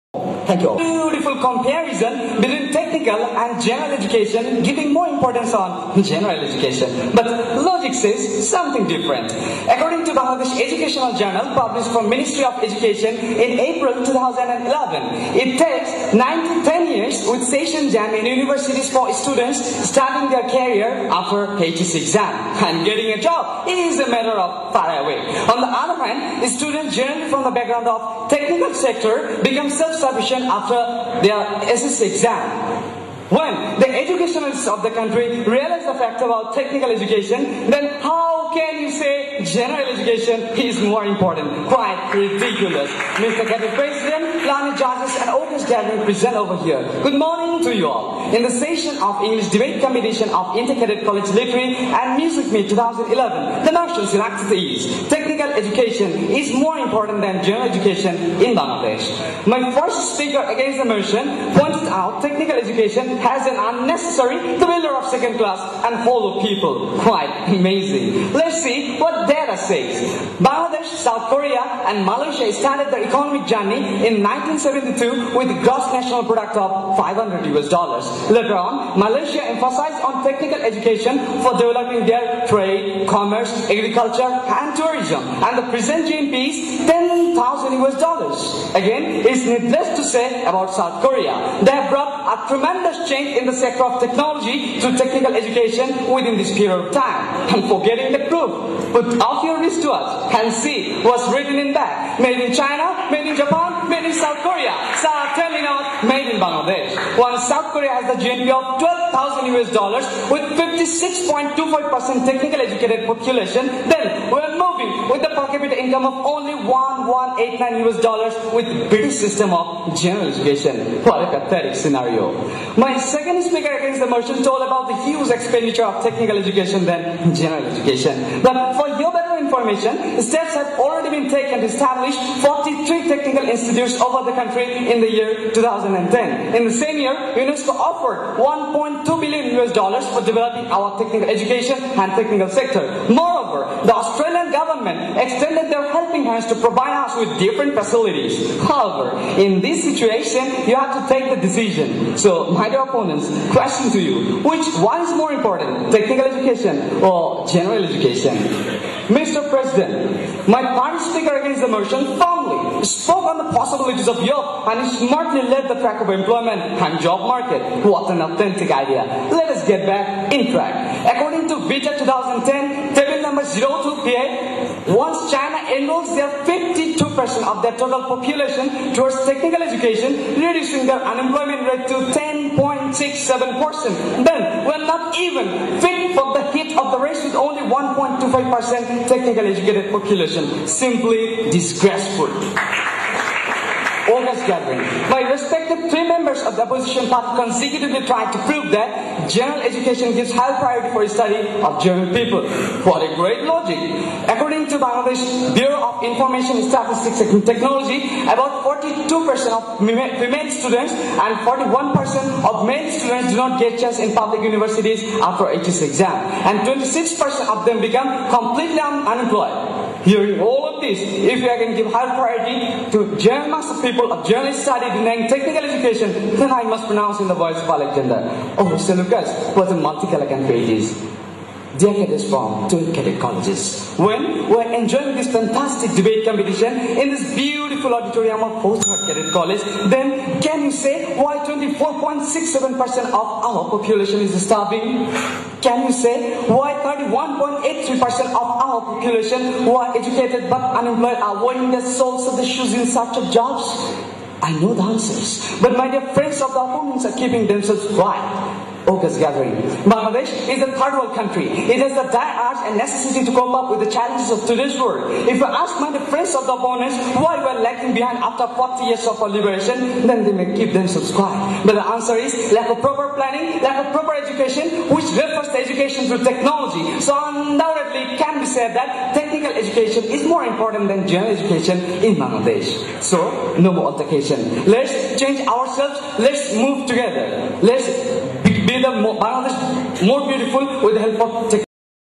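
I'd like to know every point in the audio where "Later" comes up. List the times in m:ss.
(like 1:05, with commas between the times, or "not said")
1:18.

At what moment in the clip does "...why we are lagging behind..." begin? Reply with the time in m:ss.
4:27.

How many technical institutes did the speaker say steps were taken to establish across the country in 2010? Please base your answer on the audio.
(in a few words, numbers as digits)
43.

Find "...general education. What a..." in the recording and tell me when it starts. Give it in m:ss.
1:59.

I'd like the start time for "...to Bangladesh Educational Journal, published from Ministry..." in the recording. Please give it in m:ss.
0:10.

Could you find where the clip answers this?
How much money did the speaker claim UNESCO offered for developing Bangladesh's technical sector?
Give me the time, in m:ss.
2:18.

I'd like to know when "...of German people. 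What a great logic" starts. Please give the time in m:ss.
3:21.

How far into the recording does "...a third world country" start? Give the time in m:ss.
4:20.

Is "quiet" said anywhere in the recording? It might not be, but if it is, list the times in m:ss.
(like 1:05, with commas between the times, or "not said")
4:17, 4:31.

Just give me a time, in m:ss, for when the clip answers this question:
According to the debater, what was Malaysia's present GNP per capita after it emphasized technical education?
1:26.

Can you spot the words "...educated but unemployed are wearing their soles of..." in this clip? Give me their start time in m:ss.
4:09.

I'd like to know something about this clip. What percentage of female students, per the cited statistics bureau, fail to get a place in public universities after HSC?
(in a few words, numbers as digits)
42%.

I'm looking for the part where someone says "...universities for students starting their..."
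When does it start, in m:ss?
0:18.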